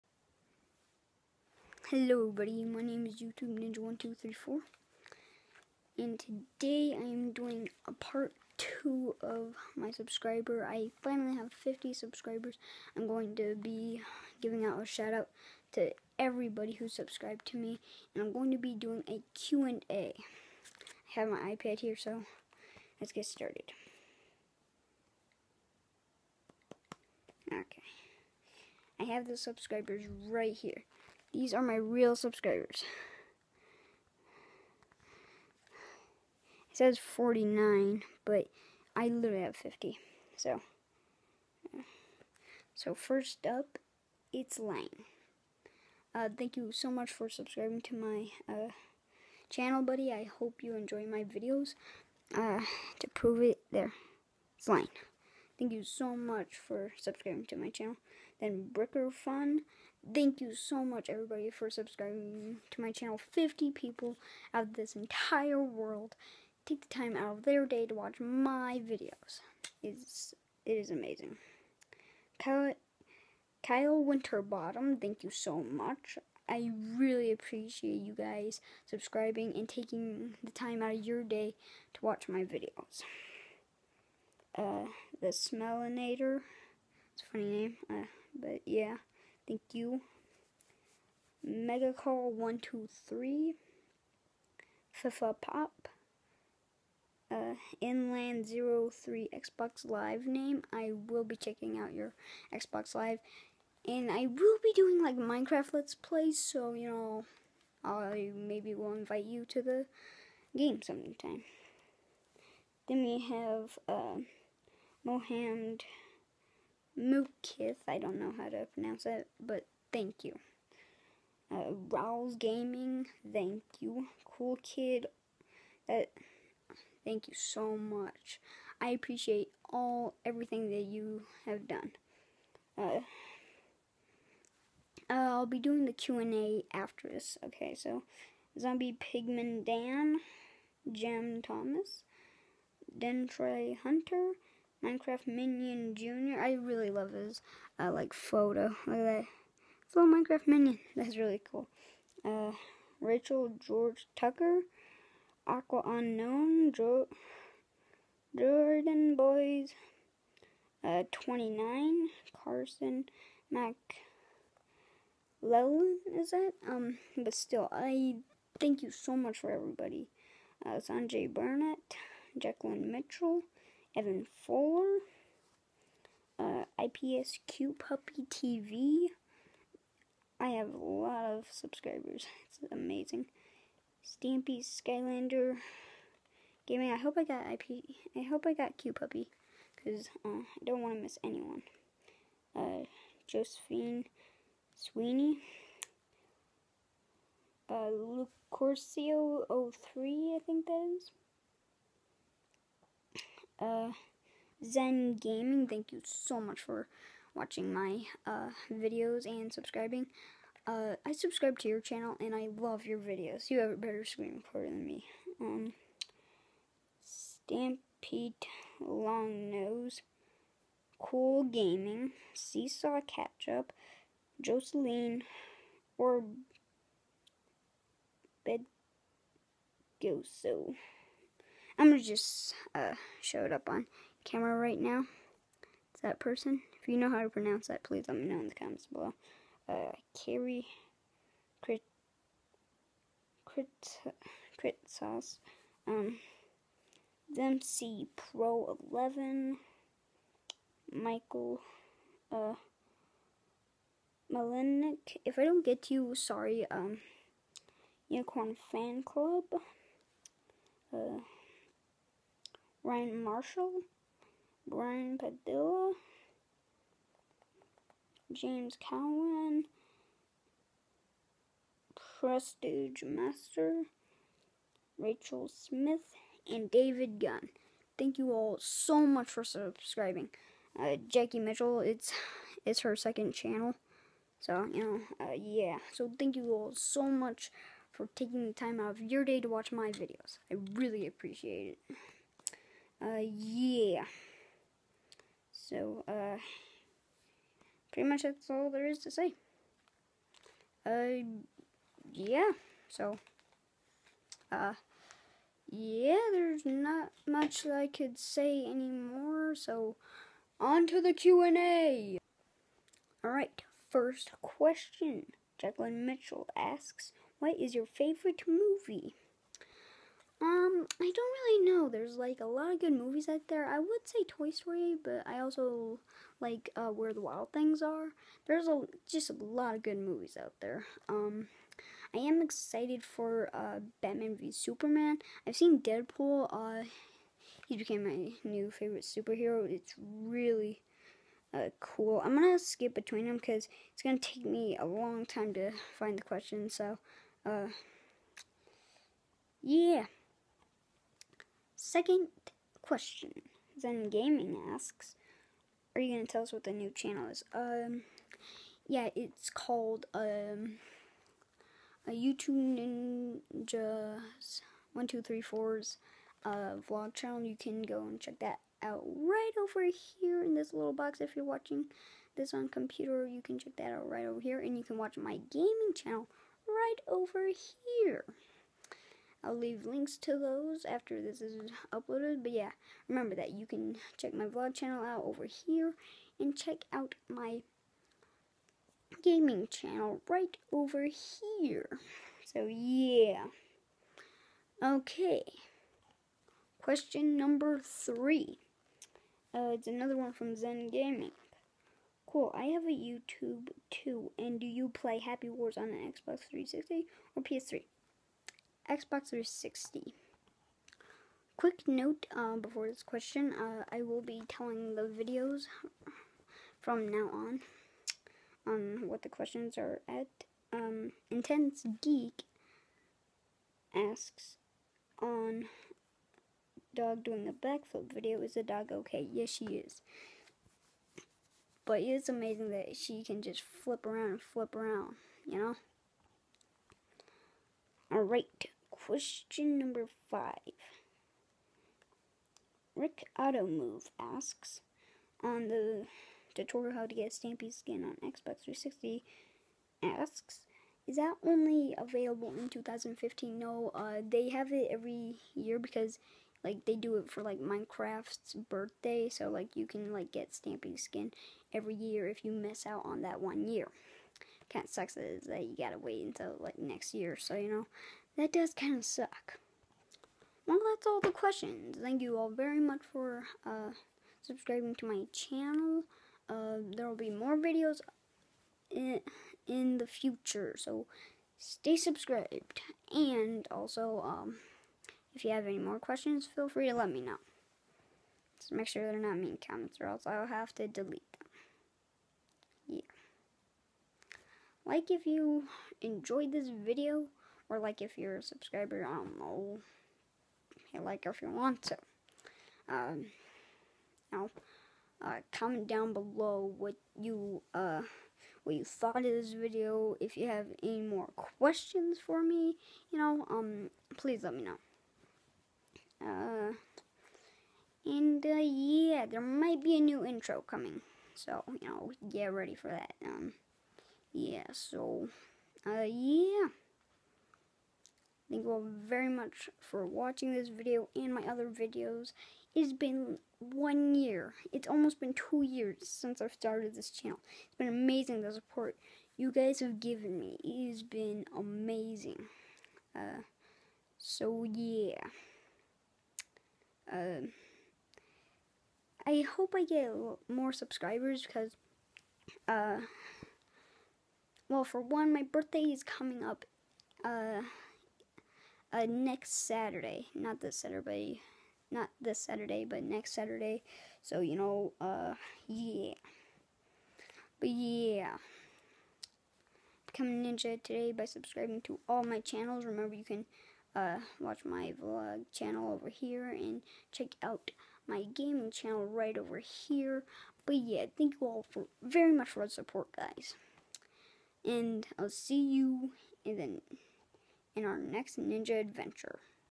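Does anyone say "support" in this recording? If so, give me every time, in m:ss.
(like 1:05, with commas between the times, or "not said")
8:58, 9:42.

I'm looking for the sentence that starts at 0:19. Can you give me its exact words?
I have my iPad here so let's get started.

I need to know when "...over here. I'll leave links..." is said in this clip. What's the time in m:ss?
6:17.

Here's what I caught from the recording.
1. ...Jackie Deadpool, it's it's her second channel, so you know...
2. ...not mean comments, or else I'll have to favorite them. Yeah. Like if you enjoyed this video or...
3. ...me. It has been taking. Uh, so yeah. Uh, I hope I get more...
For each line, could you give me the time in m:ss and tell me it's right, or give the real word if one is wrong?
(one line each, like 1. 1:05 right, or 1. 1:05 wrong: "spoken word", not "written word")
1. 4:41 wrong: "Mitchell", not "Deadpool"
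2. 8:09 wrong: "delete", not "favorite"
3. 9:00 wrong: "amazing", not "taking".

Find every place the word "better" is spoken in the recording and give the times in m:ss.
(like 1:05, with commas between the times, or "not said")
3:33.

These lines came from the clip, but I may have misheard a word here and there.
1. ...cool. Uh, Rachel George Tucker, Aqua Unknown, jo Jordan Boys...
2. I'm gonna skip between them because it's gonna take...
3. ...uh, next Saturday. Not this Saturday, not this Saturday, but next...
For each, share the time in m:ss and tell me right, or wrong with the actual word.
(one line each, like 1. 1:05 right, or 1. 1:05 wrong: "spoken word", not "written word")
1. 2:31 right
2. 5:42 right
3. 9:18 right.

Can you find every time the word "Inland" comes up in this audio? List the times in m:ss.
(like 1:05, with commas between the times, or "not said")
1:37.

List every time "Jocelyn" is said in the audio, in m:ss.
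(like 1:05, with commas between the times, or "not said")
3:44.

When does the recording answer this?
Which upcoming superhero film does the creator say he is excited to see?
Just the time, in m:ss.
5:34.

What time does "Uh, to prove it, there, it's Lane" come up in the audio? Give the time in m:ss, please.
0:52.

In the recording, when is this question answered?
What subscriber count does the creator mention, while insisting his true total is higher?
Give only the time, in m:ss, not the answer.
0:36.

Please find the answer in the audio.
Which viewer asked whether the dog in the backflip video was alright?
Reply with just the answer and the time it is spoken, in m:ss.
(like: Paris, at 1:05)
Intense Geek, at 7:01.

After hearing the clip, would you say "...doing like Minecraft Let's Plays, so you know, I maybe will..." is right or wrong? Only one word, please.
right.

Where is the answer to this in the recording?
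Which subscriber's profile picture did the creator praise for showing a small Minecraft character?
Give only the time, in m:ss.
2:24.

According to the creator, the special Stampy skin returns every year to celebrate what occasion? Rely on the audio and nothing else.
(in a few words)
Minecraft's birthday.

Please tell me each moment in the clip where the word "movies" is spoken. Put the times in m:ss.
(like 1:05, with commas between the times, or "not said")
5:18, 5:22, 5:29.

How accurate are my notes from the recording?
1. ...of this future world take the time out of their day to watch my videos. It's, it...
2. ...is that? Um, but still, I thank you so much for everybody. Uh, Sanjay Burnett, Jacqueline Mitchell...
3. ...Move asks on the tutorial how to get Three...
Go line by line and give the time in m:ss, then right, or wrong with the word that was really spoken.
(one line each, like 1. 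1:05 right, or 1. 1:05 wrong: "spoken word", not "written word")
1. 1:04 wrong: "entire", not "future"
2. 2:46 right
3. 7:23 wrong: "Stampy", not "Three".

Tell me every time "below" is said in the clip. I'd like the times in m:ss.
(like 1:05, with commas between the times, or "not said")
3:58, 8:26.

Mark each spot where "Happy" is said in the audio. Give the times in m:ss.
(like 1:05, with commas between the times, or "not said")
6:45.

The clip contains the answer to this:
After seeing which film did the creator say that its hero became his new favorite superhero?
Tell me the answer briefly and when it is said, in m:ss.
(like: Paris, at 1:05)
Deadpool, at 5:35.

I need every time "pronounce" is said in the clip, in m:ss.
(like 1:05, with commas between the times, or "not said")
1:58, 3:57.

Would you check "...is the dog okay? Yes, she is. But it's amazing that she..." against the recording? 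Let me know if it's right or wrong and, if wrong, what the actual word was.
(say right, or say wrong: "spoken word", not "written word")
right.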